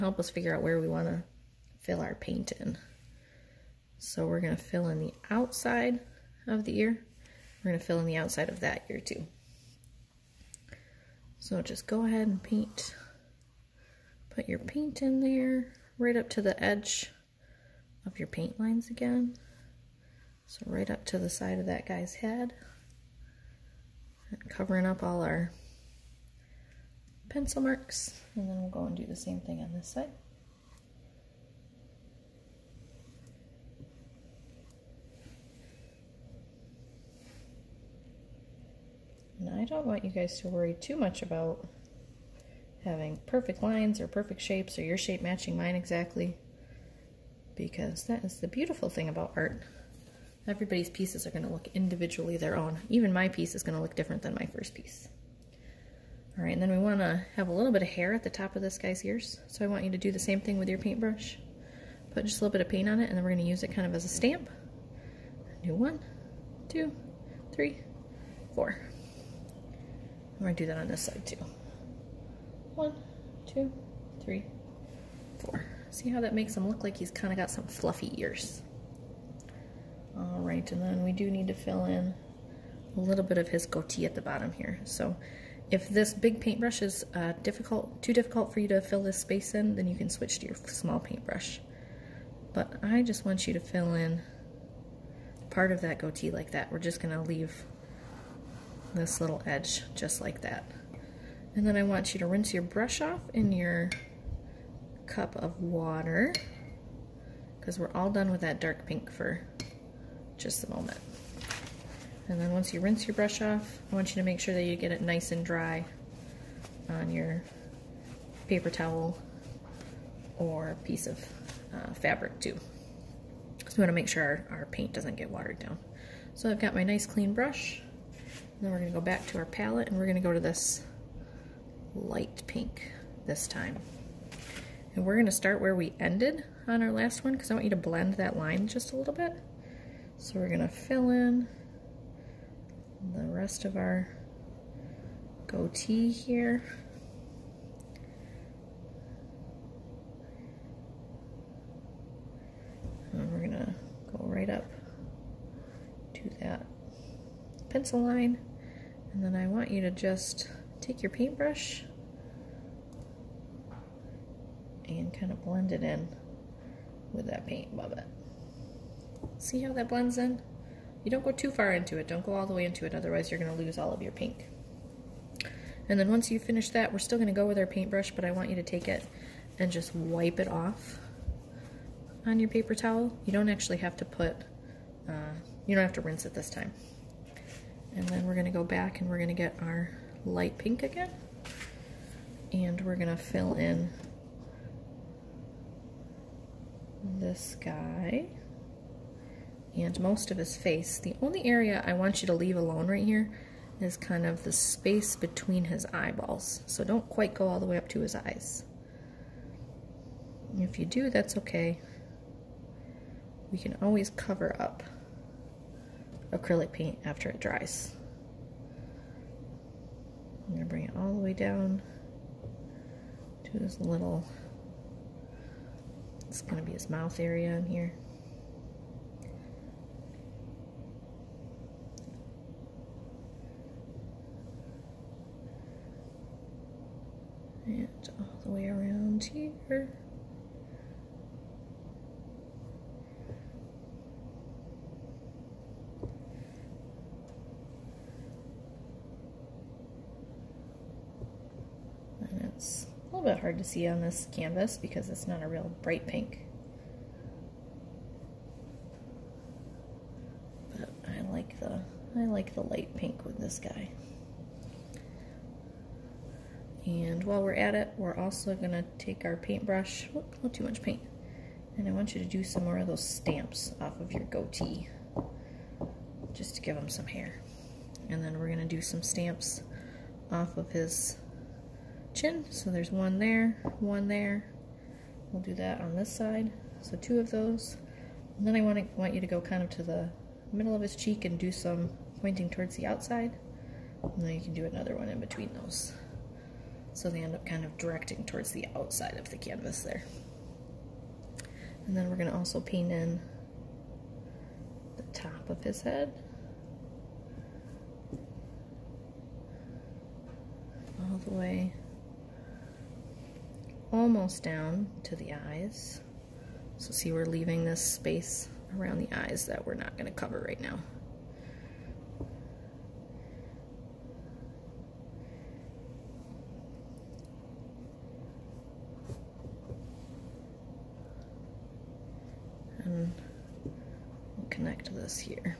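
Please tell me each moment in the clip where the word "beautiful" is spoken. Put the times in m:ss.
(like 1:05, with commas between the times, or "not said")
0:48.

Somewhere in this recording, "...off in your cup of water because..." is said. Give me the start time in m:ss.
1:43.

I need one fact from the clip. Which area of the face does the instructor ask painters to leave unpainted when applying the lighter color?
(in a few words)
between his eyeballs.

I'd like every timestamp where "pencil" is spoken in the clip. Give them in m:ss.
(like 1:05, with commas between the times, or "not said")
0:27, 2:37.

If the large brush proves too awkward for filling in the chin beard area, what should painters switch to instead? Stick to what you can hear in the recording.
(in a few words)
small paintbrush.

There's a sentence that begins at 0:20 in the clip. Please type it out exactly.
So right up to the side of that guy's head.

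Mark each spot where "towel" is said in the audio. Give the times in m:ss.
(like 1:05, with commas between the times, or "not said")
1:58, 3:02.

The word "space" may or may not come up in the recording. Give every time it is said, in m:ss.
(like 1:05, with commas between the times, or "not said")
1:29, 3:24, 5:17.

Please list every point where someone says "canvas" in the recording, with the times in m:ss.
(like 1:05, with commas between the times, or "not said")
4:14, 4:59.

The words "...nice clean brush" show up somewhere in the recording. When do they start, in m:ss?
2:06.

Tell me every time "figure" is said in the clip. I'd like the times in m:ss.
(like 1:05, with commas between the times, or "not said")
0:00.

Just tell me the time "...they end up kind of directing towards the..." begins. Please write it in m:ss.
4:57.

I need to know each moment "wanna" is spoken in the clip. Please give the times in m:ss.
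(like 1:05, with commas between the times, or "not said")
0:00, 0:56.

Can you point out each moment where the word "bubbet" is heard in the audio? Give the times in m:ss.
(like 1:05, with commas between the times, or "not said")
2:47.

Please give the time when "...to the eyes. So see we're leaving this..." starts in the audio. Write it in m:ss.
5:15.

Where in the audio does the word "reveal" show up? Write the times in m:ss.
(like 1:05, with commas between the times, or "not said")
not said.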